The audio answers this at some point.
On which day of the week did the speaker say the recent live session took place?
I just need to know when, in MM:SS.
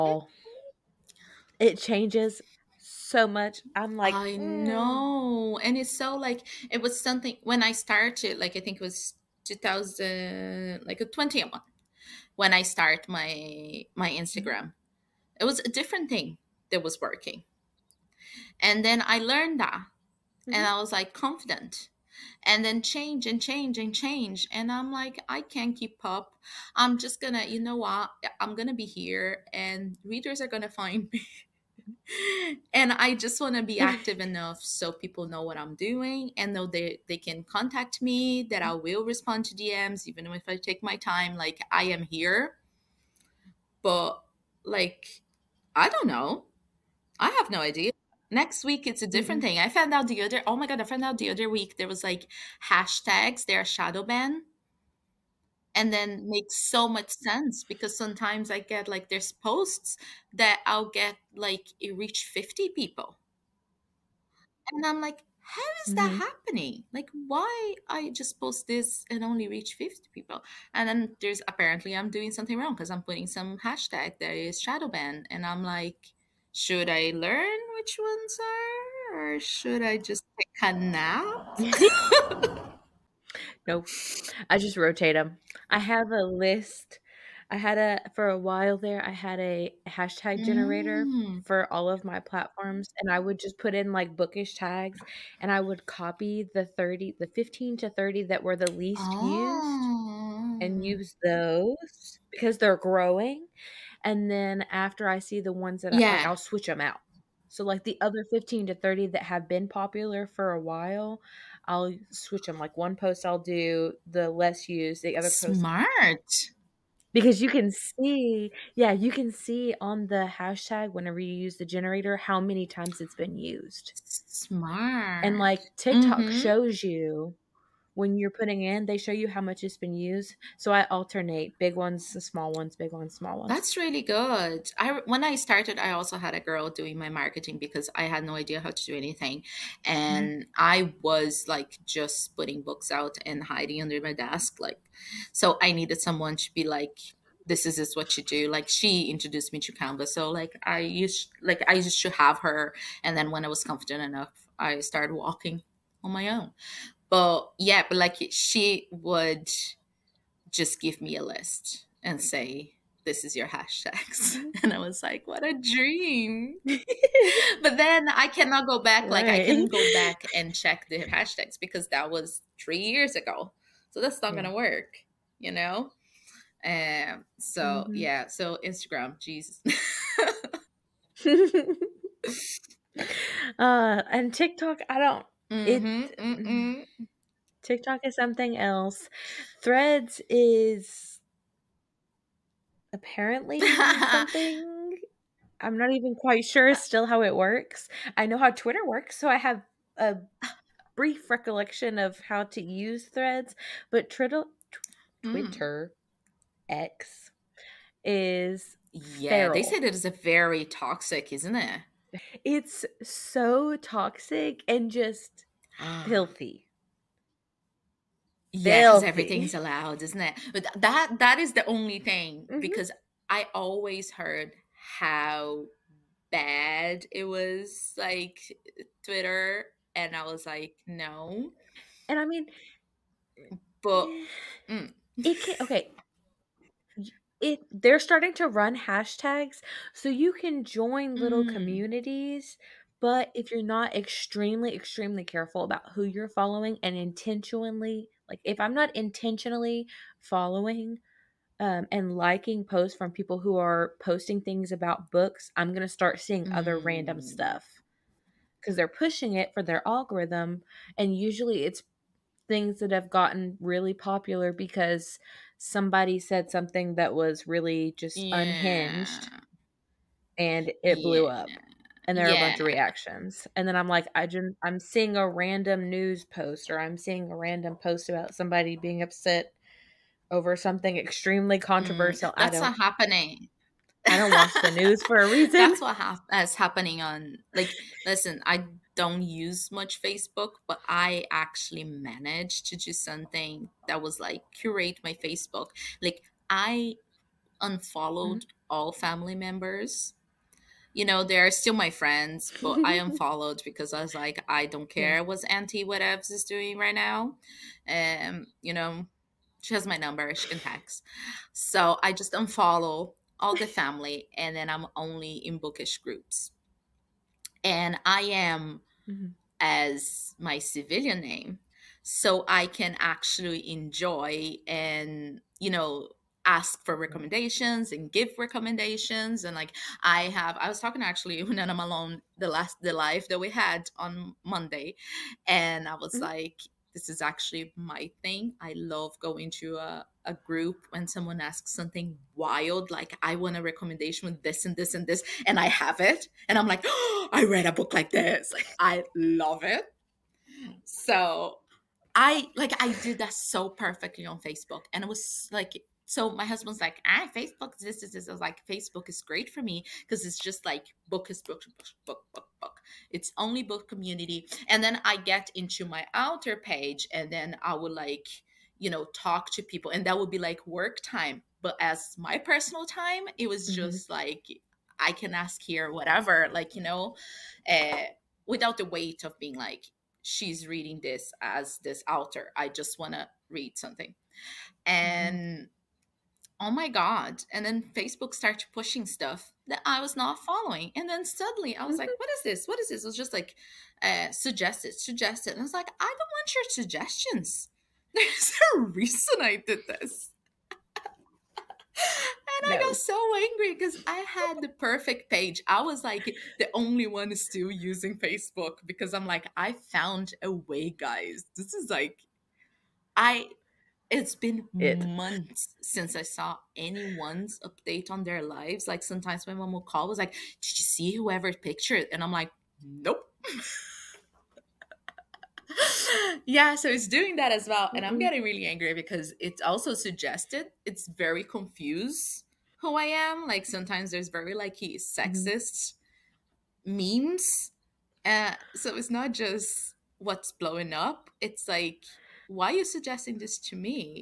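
05:34.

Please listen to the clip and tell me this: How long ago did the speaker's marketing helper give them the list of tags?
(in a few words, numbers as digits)
three years ago.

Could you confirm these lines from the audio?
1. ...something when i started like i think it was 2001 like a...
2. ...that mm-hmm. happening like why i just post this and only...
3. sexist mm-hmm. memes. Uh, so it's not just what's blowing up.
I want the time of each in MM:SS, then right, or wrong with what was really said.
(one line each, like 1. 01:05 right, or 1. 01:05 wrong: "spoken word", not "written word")
1. 00:07 wrong: "2000", not "2001"
2. 01:05 right
3. 07:15 right.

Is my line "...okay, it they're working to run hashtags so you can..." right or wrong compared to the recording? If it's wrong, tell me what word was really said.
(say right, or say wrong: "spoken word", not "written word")
wrong: "starting", not "working".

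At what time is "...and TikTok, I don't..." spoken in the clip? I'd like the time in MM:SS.
03:04.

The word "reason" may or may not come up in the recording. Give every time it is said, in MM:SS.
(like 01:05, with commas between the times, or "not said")
04:45, 06:38.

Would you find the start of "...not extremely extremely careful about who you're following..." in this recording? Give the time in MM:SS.
04:03.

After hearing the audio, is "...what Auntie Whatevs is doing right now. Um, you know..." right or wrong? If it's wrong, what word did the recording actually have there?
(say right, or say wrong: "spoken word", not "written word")
right.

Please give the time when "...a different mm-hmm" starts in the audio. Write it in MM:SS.
00:49.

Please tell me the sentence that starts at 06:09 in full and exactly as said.
And that would be like work time.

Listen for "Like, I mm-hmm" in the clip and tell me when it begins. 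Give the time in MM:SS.
04:56.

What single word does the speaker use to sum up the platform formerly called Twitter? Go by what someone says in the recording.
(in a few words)
feral.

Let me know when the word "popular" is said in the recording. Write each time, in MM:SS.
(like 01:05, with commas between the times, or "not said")
01:49, 04:23.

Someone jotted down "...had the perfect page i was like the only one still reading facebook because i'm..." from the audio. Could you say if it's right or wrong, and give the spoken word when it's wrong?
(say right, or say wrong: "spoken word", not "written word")
wrong: "using", not "reading".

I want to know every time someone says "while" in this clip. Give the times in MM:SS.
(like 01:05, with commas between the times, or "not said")
01:28, 01:50.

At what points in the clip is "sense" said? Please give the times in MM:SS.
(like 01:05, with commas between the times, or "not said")
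00:57.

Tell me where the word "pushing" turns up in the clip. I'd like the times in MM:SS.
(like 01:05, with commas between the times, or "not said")
04:18, 06:28.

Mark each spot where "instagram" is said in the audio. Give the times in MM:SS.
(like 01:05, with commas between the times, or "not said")
00:14, 02:58.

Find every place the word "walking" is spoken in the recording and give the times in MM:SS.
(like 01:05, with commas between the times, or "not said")
02:35.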